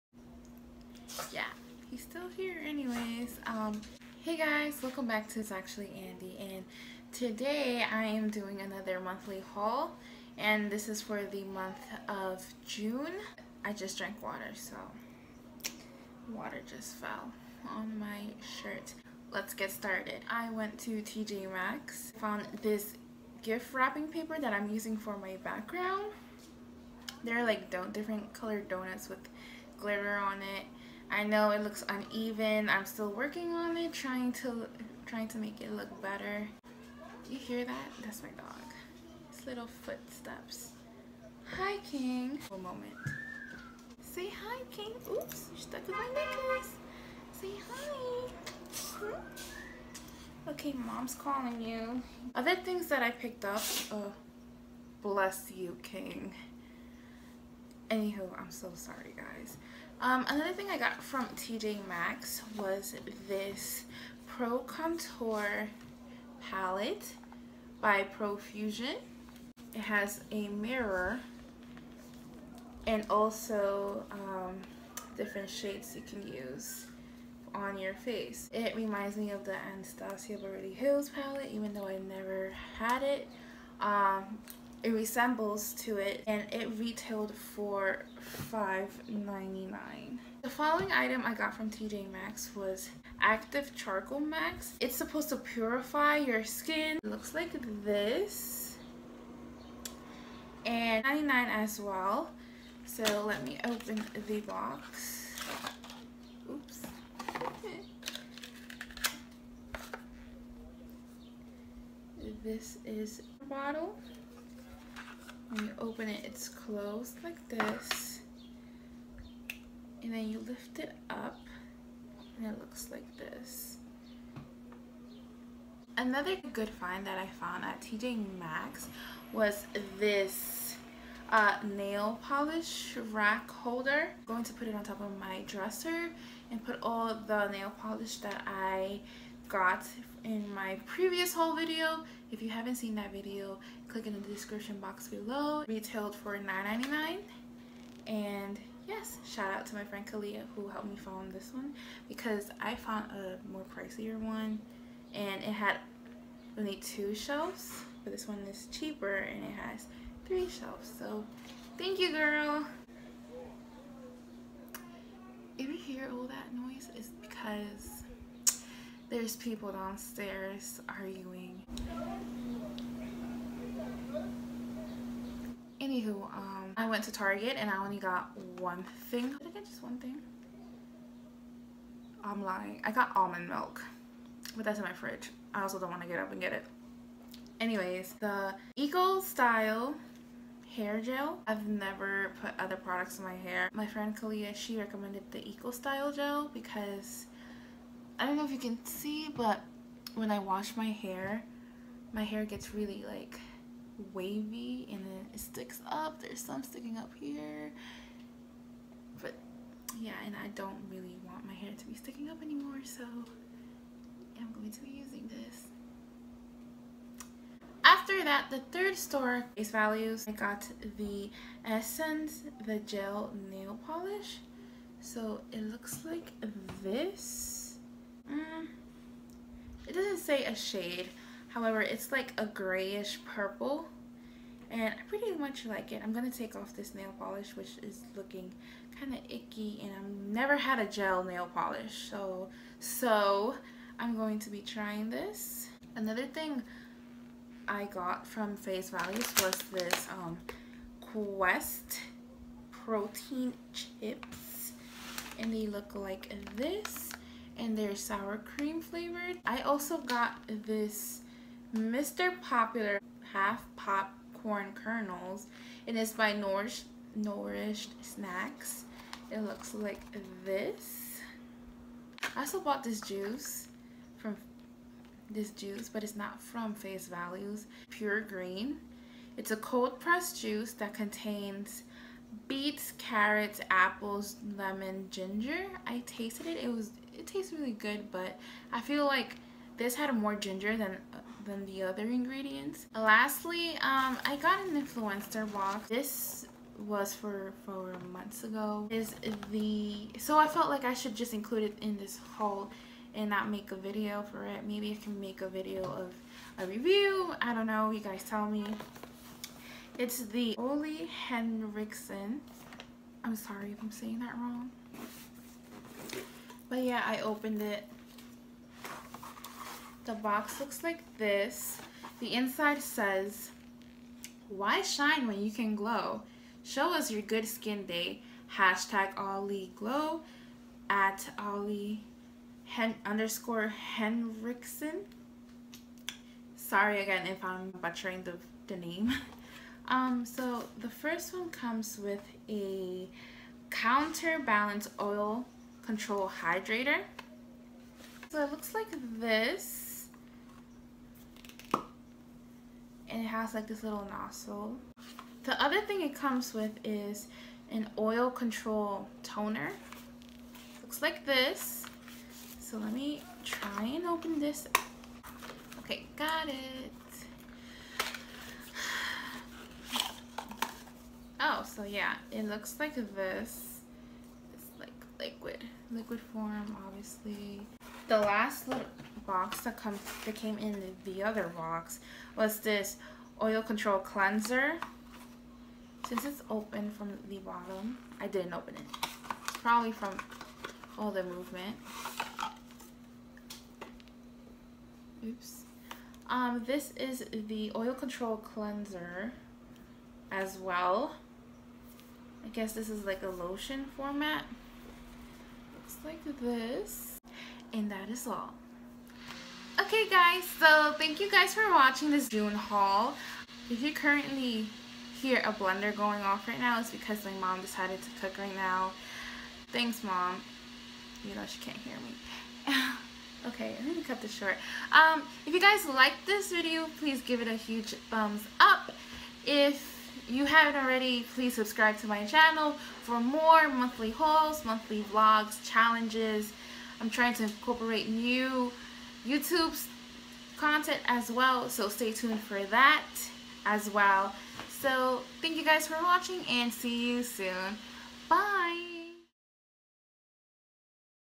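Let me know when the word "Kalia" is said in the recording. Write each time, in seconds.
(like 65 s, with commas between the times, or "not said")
150 s, 194 s.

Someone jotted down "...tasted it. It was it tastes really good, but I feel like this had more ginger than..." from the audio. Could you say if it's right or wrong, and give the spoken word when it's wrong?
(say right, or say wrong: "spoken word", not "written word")
right.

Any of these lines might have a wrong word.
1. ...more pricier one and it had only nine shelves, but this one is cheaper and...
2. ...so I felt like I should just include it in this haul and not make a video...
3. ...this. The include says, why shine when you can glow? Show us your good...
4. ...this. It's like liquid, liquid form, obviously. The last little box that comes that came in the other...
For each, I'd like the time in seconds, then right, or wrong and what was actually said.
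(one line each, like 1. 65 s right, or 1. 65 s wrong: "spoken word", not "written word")
1. 153 s wrong: "two", not "nine"
2. 300 s right
3. 321 s wrong: "inside", not "include"
4. 372 s right.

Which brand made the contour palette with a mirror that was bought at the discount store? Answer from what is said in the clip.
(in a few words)
Profusion.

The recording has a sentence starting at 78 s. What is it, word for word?
It reminds me of the Anastasia Beverly Hills palette even though I never had it.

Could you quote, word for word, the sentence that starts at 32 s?
I'm still working on it, trying to trying to make it look better.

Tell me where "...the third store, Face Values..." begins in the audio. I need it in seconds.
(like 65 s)
218 s.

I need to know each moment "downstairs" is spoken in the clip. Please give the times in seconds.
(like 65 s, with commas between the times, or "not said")
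169 s.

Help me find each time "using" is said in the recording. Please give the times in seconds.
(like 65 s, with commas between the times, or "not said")
24 s, 214 s.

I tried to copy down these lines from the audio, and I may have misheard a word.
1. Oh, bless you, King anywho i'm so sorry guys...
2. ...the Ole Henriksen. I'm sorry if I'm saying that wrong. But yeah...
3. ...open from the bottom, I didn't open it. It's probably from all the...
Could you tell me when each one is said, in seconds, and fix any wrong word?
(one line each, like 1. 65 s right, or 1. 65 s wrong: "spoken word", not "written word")
1. 53 s right
2. 310 s right
3. 386 s right.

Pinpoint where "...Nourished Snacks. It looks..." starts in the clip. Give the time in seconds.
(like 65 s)
267 s.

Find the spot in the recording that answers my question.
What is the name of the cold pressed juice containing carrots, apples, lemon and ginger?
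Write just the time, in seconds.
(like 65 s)
277 s.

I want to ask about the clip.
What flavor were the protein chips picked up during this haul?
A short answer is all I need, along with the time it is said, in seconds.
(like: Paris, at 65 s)
Sour cream, at 257 s.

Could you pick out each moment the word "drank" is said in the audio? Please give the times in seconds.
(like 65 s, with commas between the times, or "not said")
13 s.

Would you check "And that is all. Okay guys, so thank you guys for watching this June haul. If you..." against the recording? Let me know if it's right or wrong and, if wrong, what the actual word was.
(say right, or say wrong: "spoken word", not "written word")
right.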